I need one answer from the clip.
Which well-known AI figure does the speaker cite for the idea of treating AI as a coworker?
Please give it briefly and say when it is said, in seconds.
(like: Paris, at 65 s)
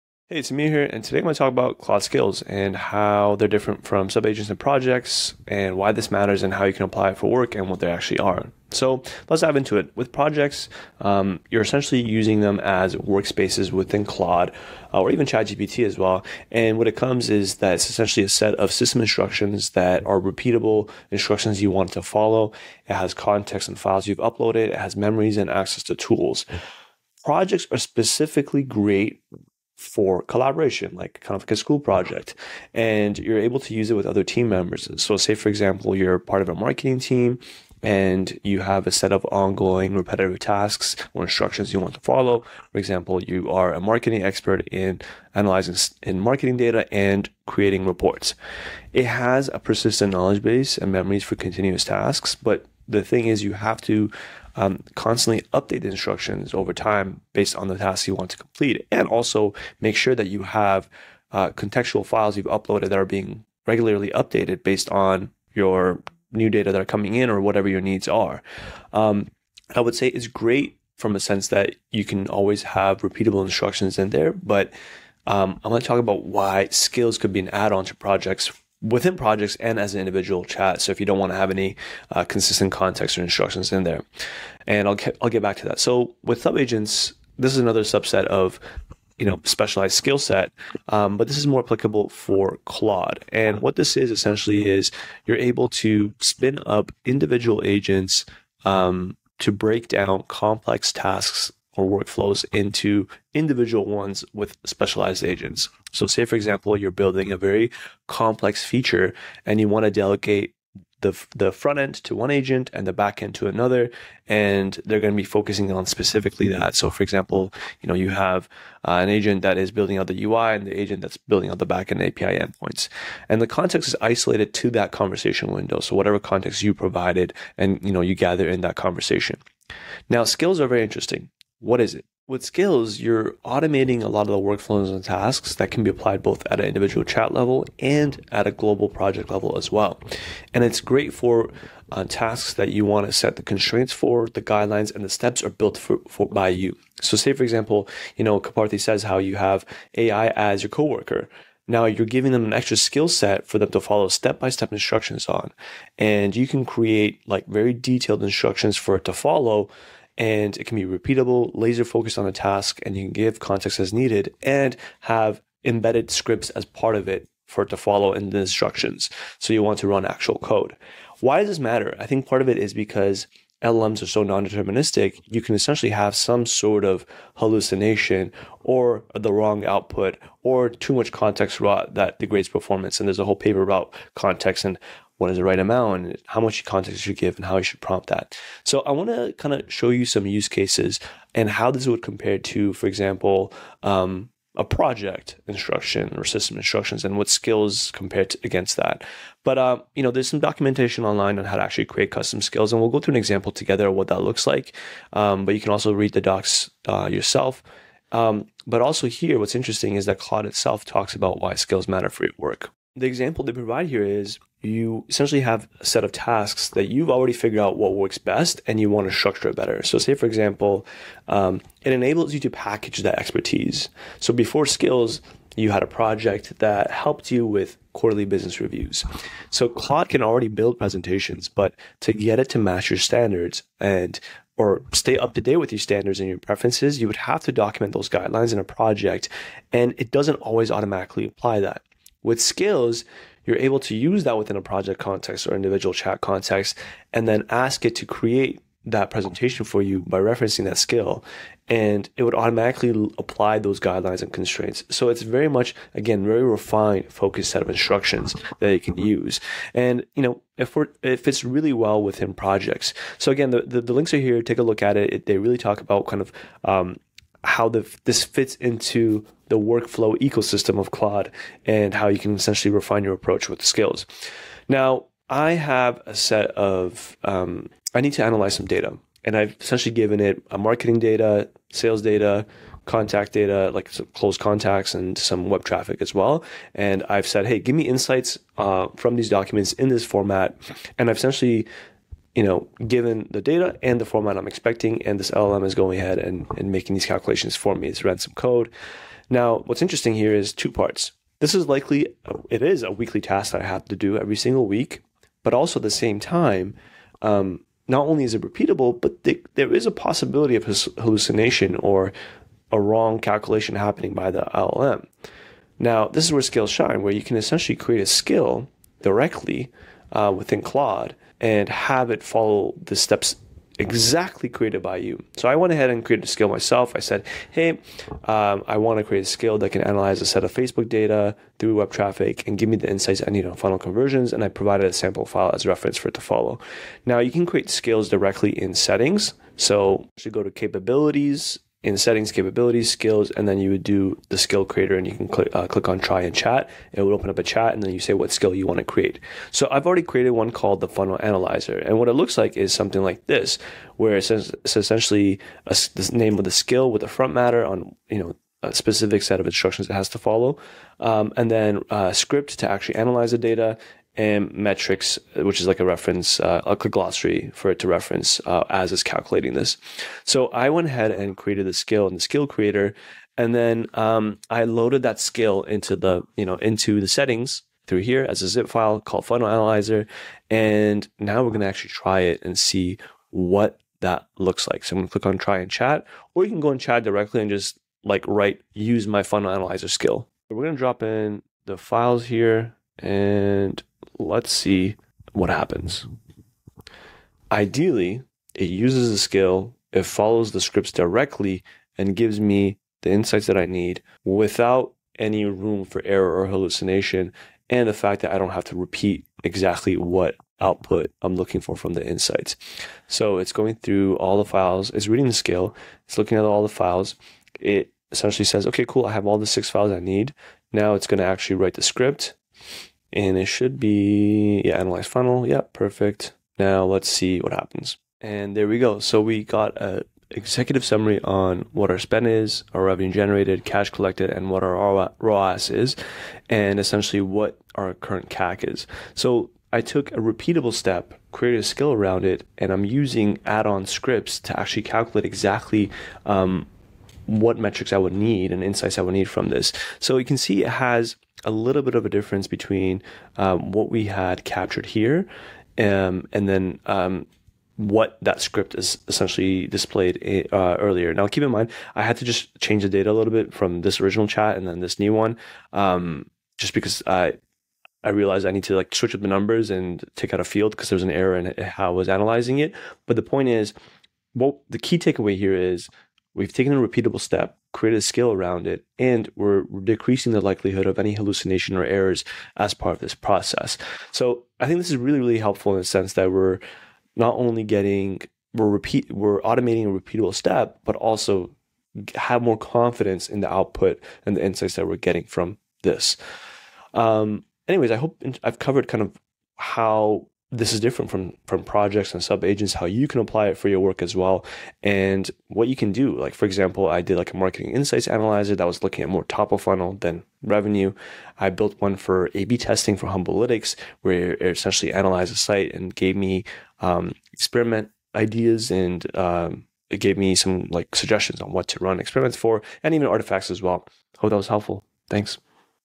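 Karpathy, at 148 s.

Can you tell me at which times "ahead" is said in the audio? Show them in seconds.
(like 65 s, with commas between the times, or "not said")
295 s, 325 s, 370 s.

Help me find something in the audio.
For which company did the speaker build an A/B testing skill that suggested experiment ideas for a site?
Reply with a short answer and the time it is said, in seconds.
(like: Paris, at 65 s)
Humblytics, at 513 s.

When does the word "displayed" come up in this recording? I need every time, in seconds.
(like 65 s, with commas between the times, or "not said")
459 s.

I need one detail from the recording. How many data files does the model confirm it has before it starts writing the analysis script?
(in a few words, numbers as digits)
6.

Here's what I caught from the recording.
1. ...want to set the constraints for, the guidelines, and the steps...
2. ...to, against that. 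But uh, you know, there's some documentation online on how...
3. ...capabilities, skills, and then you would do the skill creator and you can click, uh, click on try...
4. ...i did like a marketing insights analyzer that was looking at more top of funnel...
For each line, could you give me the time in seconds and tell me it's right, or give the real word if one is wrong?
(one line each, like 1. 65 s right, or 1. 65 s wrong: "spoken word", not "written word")
1. 142 s right
2. 198 s right
3. 342 s right
4. 506 s right.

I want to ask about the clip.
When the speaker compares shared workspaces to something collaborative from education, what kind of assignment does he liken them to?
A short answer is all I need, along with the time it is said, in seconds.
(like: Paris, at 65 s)
school project, at 31 s.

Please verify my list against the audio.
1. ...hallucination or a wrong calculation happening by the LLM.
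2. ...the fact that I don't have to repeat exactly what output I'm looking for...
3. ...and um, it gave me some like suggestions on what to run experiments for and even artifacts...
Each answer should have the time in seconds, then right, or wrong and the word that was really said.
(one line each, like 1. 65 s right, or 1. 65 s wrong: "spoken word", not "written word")
1. 310 s right
2. 407 s right
3. 518 s right.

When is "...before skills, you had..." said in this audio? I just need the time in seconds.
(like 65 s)
224 s.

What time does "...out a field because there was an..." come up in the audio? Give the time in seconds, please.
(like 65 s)
470 s.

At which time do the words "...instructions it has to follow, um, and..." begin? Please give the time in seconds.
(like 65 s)
359 s.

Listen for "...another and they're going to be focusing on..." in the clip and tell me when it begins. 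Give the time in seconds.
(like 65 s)
113 s.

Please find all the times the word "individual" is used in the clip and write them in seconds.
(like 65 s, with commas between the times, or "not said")
79 s, 97 s, 103 s, 136 s, 245 s.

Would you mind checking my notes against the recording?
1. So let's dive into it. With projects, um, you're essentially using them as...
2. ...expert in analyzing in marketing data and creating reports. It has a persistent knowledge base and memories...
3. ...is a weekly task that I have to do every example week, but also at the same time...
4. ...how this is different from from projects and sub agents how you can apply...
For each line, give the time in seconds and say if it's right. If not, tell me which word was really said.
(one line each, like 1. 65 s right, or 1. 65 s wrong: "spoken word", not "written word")
1. 8 s right
2. 44 s right
3. 302 s wrong: "single", not "example"
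4. 499 s right.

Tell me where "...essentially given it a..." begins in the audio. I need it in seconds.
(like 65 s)
279 s.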